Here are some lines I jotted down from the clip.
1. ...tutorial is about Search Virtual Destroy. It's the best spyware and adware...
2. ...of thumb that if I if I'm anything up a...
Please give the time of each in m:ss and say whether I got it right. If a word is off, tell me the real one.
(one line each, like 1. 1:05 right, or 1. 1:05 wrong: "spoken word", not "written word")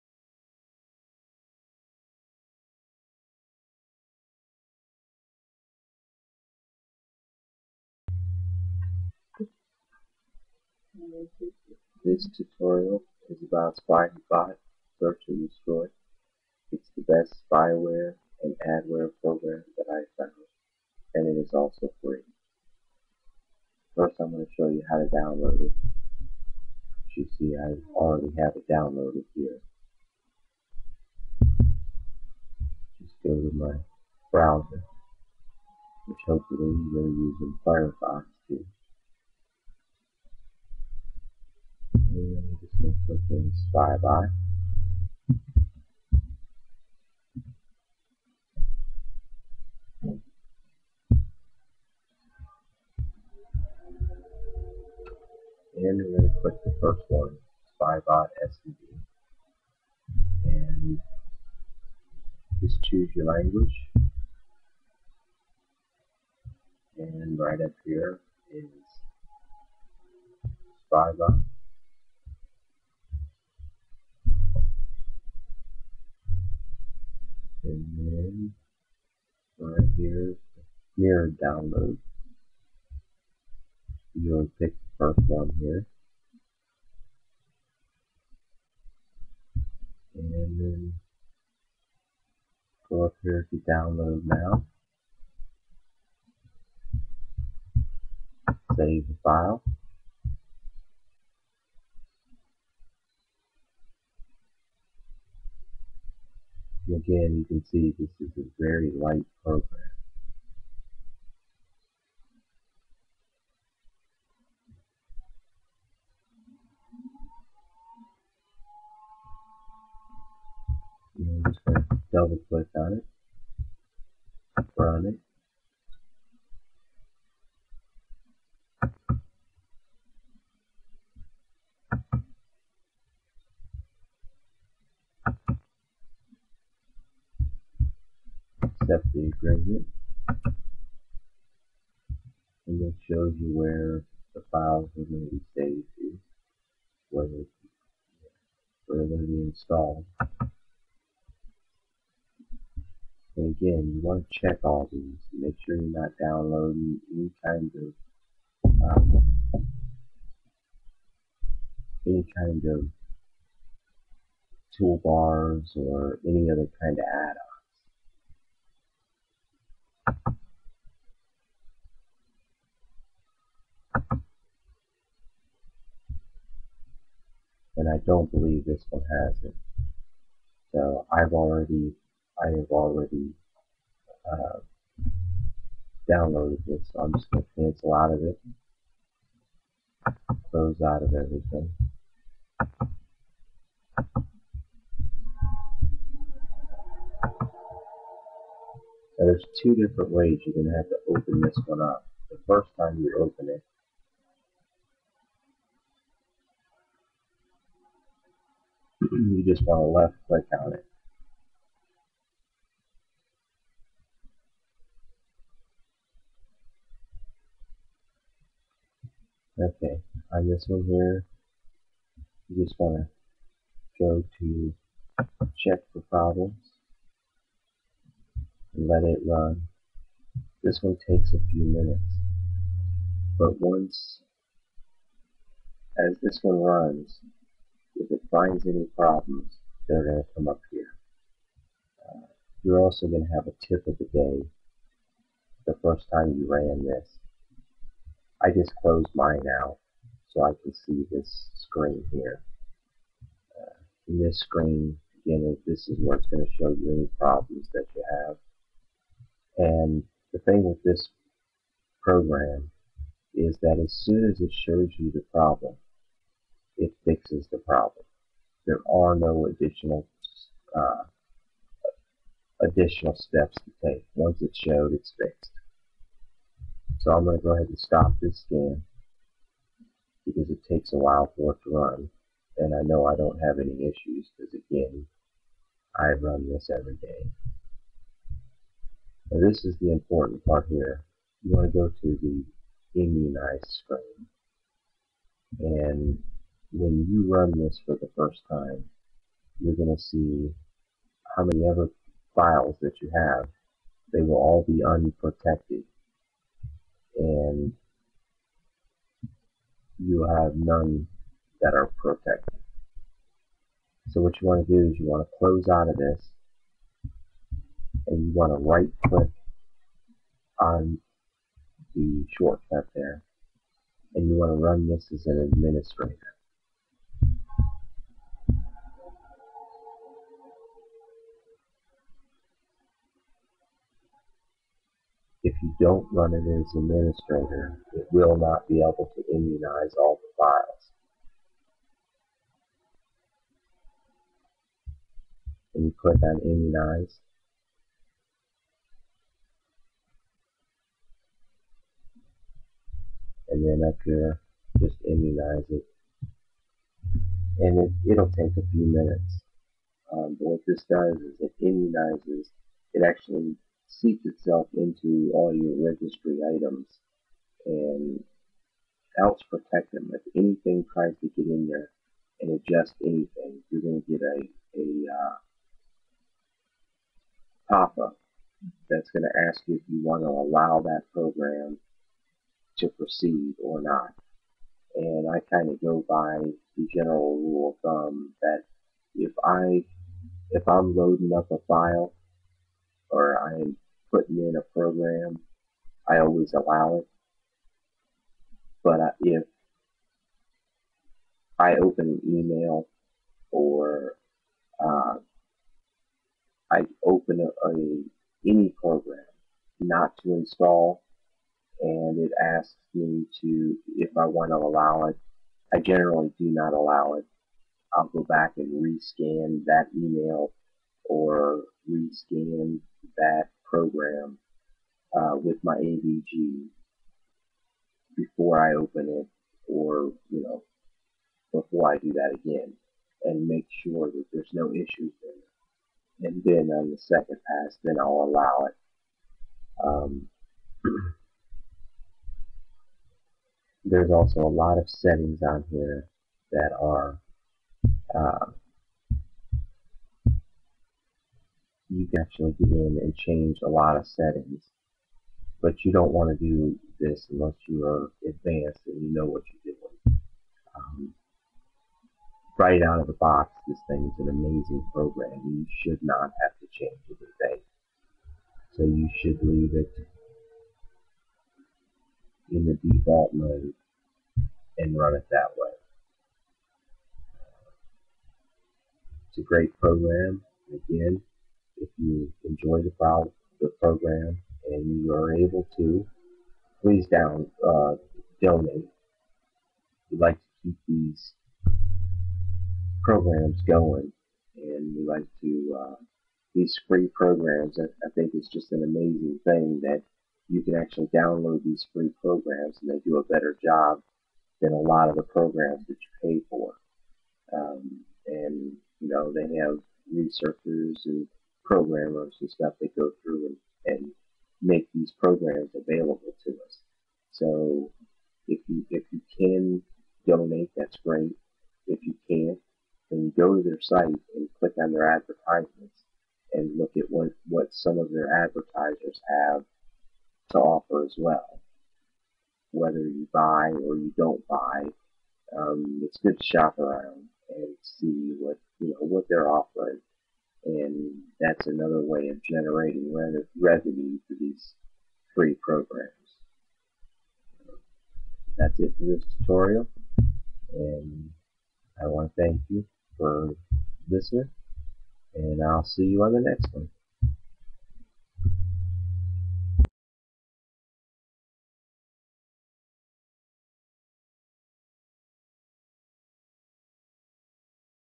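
1. 0:12 right
2. 6:27 wrong: "loading", not "anything".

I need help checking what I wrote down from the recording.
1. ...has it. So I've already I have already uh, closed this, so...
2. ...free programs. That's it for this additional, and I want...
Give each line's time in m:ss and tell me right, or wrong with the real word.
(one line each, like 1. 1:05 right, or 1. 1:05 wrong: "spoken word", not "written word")
1. 2:59 wrong: "downloaded", not "closed"
2. 9:05 wrong: "tutorial", not "additional".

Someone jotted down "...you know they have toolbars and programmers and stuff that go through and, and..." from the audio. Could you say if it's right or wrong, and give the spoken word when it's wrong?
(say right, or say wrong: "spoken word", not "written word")
wrong: "researchers", not "toolbars".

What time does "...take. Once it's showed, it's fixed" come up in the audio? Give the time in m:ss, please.
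4:33.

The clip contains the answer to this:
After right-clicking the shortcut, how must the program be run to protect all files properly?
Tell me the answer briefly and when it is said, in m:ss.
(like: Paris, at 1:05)
as an administrator, at 5:25.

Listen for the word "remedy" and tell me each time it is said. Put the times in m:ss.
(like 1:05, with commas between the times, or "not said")
not said.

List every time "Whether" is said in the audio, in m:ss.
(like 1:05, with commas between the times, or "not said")
8:52.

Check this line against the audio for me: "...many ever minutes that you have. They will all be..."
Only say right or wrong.
wrong.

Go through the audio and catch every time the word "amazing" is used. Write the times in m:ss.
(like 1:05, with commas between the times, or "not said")
7:44, 8:18.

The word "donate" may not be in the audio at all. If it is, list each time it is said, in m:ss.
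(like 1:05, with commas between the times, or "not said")
8:08, 8:40.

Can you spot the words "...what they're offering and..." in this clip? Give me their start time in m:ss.
8:58.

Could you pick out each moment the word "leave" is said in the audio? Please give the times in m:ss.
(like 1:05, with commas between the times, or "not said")
7:49.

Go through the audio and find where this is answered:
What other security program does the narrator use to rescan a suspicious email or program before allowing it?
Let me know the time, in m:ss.
7:05.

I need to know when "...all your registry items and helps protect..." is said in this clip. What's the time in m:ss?
6:05.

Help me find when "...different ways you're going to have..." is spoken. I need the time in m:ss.
3:19.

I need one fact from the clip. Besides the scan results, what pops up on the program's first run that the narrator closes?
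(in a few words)
tip of the day.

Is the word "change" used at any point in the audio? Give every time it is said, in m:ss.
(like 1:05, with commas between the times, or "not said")
7:33, 7:46.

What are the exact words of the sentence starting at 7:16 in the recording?
And then on the second pass, then I'll allow it.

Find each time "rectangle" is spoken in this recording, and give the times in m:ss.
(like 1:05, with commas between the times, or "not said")
not said.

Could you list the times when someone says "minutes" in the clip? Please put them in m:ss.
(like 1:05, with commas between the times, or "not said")
3:51, 5:58.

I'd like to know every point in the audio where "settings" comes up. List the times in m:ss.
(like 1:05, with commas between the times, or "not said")
7:24, 7:34.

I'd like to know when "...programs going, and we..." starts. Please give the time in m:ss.
8:13.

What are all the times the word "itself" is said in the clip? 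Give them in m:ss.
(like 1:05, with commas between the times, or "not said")
6:04.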